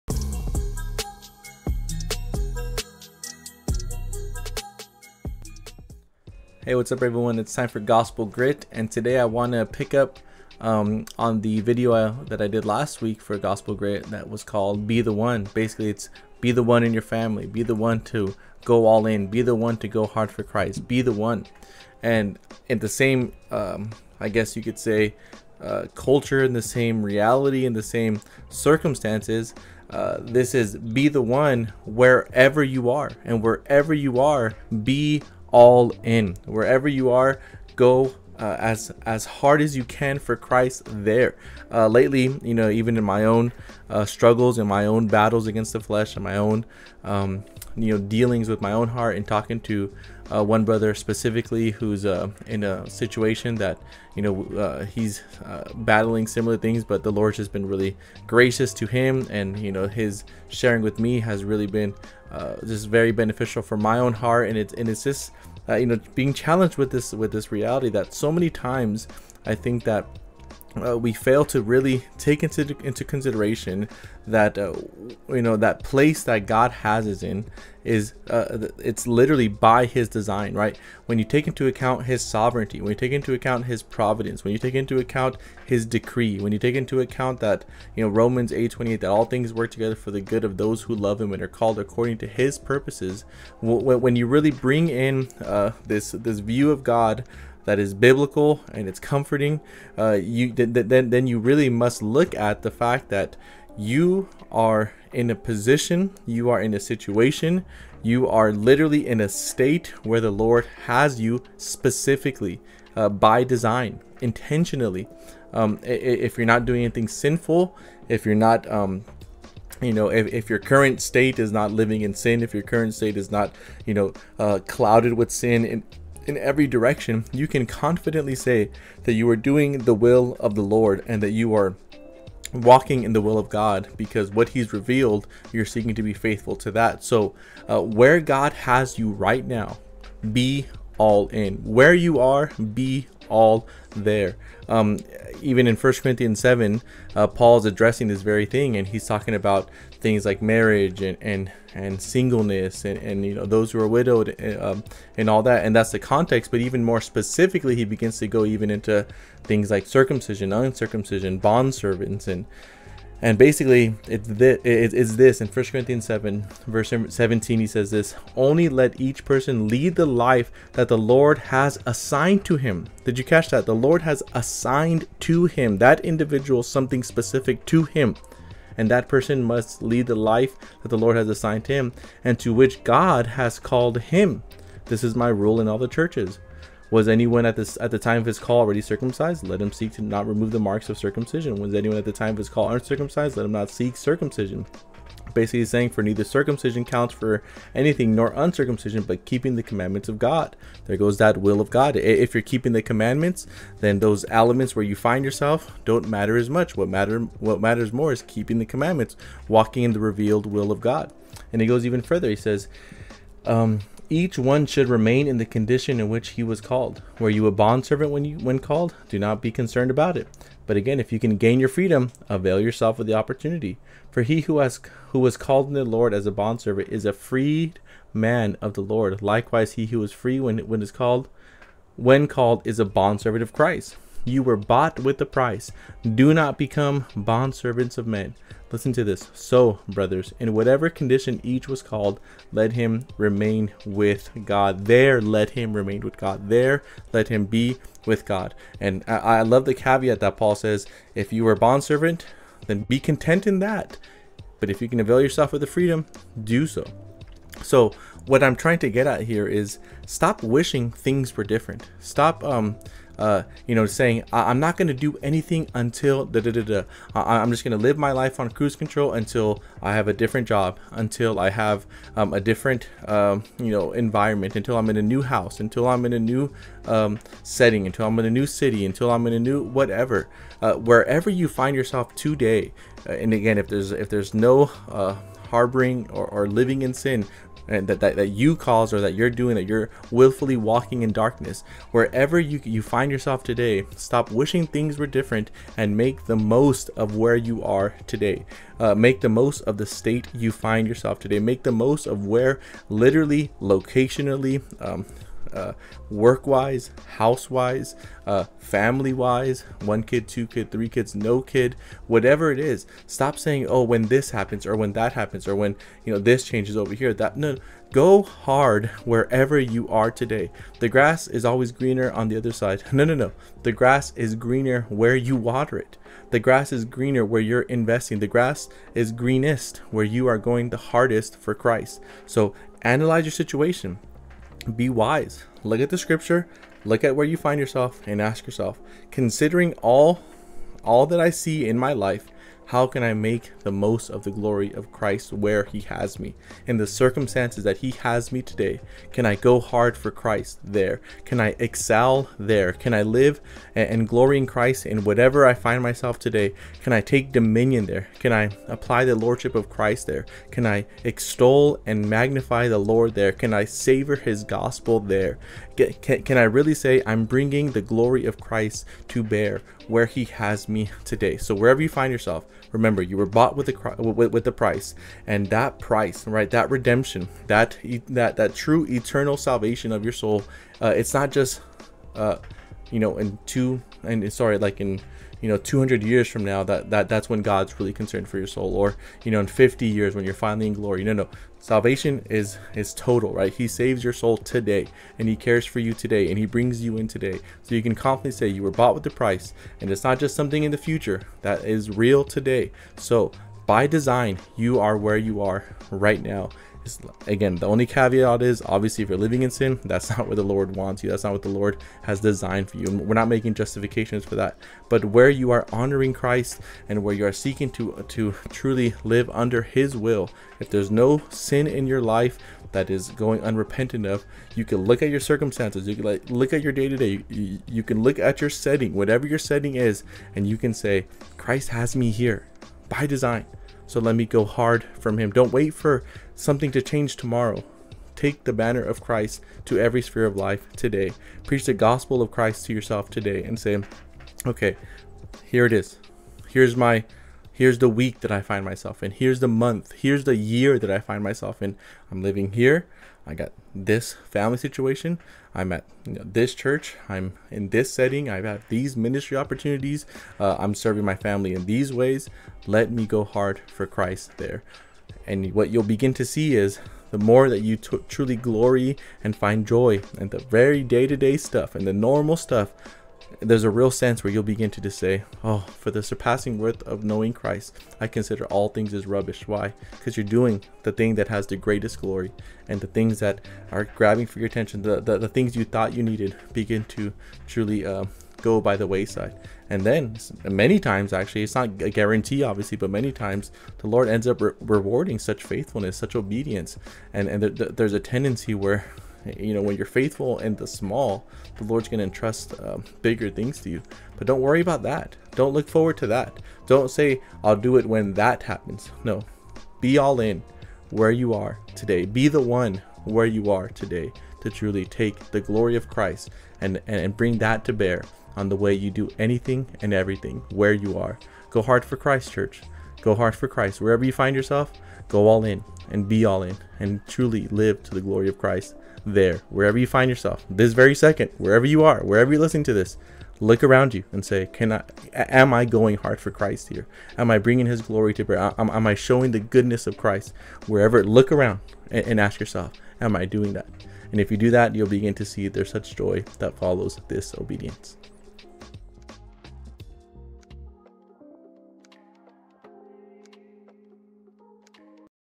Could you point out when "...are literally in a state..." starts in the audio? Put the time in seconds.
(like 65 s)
108 s.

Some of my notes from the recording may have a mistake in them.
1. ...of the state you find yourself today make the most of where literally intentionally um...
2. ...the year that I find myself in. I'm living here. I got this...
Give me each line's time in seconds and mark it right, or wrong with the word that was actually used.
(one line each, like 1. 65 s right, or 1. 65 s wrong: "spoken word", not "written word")
1. 299 s wrong: "locationally", not "intentionally"
2. 450 s right.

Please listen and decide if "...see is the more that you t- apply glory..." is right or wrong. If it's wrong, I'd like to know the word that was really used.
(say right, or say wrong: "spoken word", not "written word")
wrong: "truly", not "apply".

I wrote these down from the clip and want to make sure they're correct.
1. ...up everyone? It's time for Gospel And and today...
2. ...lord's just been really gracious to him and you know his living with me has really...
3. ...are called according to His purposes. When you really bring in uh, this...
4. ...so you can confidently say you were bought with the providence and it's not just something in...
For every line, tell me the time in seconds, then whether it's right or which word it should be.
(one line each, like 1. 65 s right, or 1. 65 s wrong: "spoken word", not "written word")
1. 6 s wrong: "Grit", not "And"
2. 57 s wrong: "sharing", not "living"
3. 91 s right
4. 397 s wrong: "price", not "providence".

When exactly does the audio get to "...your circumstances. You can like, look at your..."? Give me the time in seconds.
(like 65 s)
425 s.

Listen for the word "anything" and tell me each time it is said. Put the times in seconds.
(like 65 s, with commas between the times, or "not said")
116 s, 197 s, 265 s, 519 s.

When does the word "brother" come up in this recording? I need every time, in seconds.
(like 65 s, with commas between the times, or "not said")
50 s, 239 s.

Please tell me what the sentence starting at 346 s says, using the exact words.
In the circumstances that He has me today, can I go hard for Christ there?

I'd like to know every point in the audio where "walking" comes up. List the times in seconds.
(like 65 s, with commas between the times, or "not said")
132 s, 209 s, 290 s.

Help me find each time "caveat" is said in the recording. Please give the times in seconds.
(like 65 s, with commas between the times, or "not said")
249 s, 407 s.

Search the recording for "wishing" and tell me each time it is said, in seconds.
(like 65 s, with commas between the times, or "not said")
260 s, 294 s.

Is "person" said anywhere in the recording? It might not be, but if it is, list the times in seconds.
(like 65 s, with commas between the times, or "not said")
169 s, 179 s.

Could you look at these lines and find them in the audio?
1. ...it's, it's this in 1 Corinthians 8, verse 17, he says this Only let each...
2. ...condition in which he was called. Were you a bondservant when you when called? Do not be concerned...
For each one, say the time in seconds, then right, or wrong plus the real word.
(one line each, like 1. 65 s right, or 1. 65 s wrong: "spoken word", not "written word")
1. 164 s wrong: "7", not "8"
2. 215 s right.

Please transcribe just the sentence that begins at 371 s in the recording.
So, wherever you find yourself, Remember, you were bought with the with, with the price, and that price, right?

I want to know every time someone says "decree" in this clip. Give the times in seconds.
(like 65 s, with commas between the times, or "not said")
85 s.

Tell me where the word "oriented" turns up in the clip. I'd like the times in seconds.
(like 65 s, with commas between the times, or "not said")
not said.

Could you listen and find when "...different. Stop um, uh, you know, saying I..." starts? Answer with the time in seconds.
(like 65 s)
261 s.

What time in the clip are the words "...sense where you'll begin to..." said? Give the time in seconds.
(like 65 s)
473 s.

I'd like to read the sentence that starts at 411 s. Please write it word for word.
That's not what the Lord has designed for you.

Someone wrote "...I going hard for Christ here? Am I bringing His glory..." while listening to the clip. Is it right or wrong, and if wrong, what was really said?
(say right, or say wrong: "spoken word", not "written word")
right.